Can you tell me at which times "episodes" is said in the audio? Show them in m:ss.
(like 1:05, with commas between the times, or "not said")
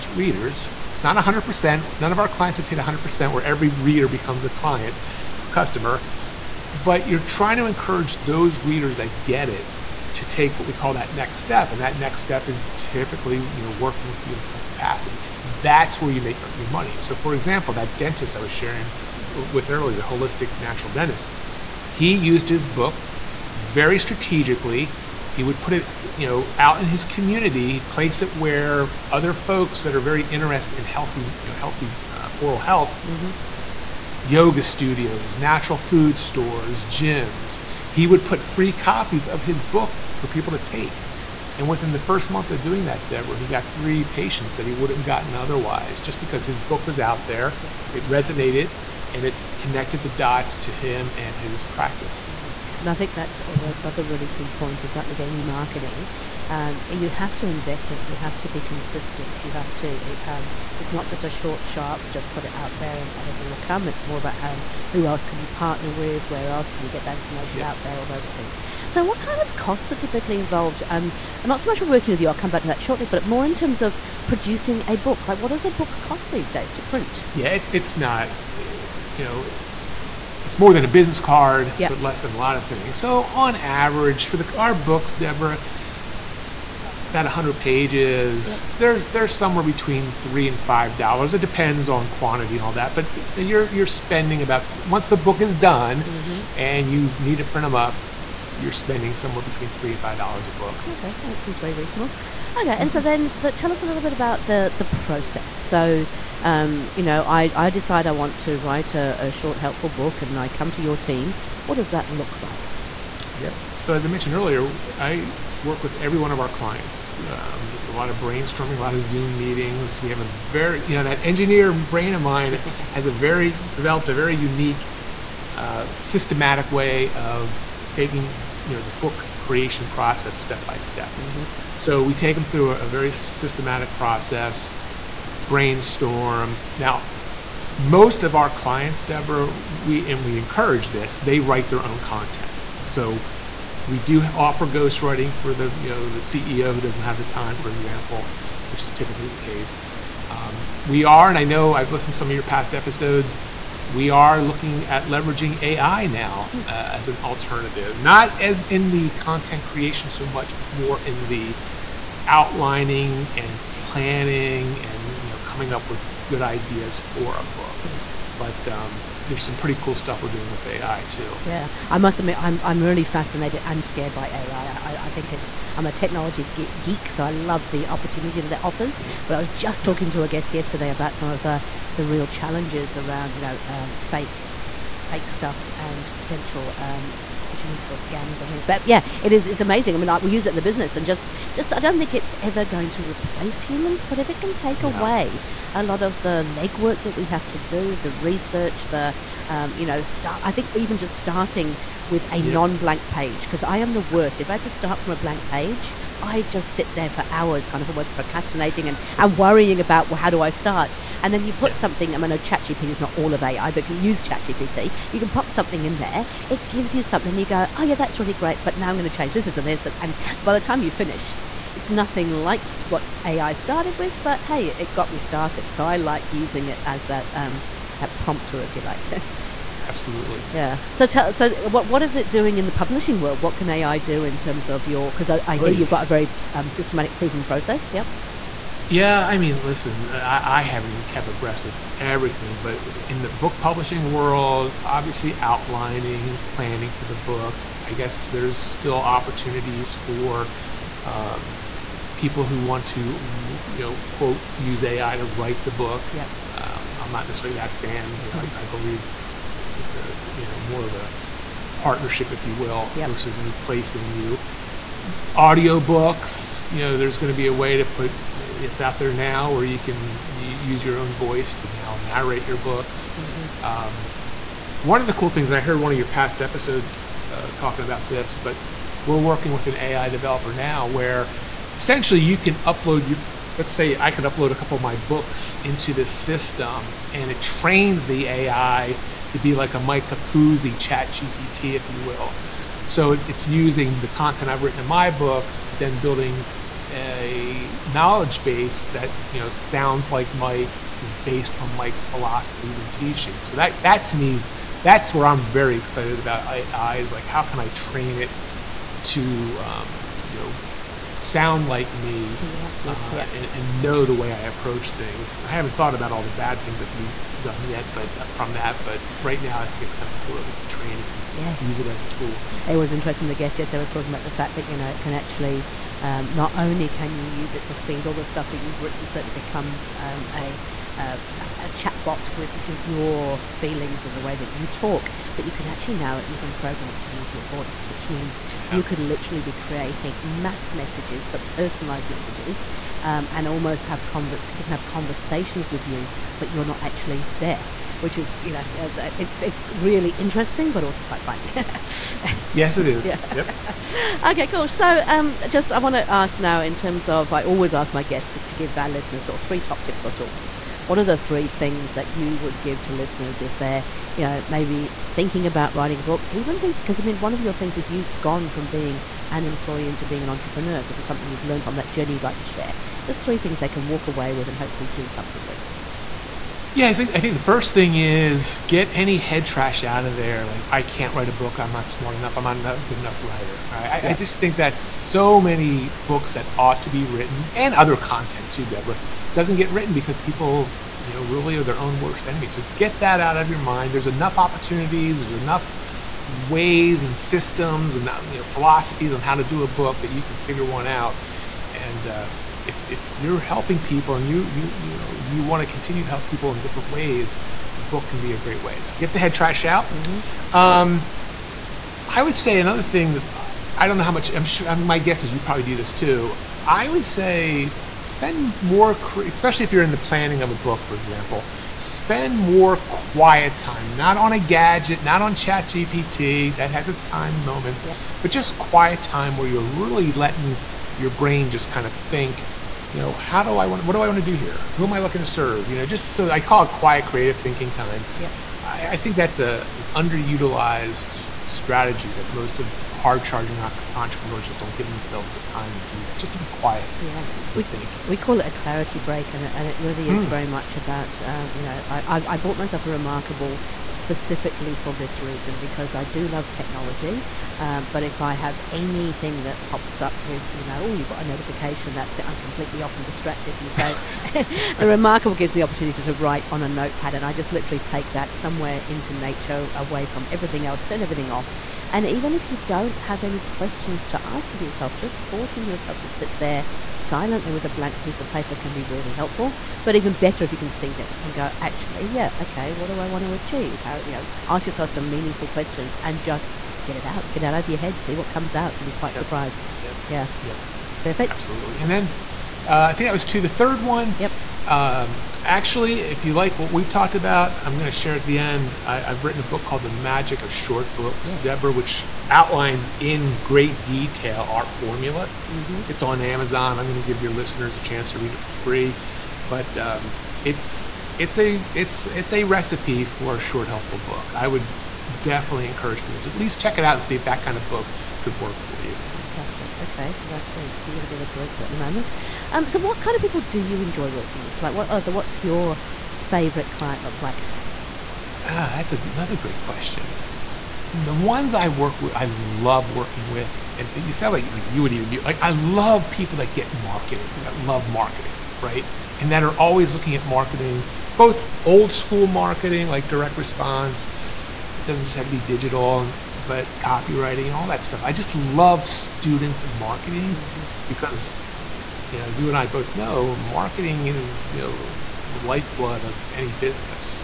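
2:32, 4:36.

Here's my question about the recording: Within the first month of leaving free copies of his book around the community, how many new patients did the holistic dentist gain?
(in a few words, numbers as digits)
3.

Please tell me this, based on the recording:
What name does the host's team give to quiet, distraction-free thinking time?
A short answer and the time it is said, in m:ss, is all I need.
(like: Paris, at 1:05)
Clarity break, at 7:28.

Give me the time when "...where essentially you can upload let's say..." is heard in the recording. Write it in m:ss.
4:40.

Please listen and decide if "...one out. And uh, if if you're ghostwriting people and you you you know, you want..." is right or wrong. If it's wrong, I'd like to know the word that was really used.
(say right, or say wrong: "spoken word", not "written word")
wrong: "helping", not "ghostwriting".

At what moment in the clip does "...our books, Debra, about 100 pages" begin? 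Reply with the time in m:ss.
1:24.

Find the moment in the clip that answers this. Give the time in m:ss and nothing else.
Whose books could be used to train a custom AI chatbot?
4:49.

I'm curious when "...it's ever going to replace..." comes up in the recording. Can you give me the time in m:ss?
3:12.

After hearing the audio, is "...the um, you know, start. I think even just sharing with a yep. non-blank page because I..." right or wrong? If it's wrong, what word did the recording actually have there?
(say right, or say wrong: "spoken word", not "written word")
wrong: "starting", not "sharing".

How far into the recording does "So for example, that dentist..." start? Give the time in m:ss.
0:16.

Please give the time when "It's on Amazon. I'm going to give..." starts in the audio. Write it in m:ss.
8:25.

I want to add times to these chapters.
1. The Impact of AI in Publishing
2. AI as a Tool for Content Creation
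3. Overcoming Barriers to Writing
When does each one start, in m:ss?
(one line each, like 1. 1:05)
1. 3:08
2. 4:52
3. 6:11.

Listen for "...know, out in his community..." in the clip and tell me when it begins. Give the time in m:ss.
0:26.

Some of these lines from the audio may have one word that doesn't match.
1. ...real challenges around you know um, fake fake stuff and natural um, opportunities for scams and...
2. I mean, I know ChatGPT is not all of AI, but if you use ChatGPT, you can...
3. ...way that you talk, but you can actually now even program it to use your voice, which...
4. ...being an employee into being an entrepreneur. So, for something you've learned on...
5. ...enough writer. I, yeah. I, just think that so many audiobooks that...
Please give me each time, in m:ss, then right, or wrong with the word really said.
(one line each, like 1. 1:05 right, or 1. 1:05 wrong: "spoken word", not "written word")
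1. 3:02 wrong: "potential", not "natural"
2. 3:32 right
3. 5:34 right
4. 6:08 right
5. 6:22 wrong: "books", not "audiobooks".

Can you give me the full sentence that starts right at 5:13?
and, and, know the way I approach things.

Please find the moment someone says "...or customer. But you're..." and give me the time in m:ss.
0:05.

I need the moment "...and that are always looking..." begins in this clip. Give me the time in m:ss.
8:59.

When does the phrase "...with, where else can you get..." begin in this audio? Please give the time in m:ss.
1:05.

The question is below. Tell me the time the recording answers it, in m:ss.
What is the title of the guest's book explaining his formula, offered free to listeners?
8:19.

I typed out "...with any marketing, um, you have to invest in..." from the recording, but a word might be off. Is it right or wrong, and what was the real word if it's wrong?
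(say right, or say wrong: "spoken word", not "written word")
right.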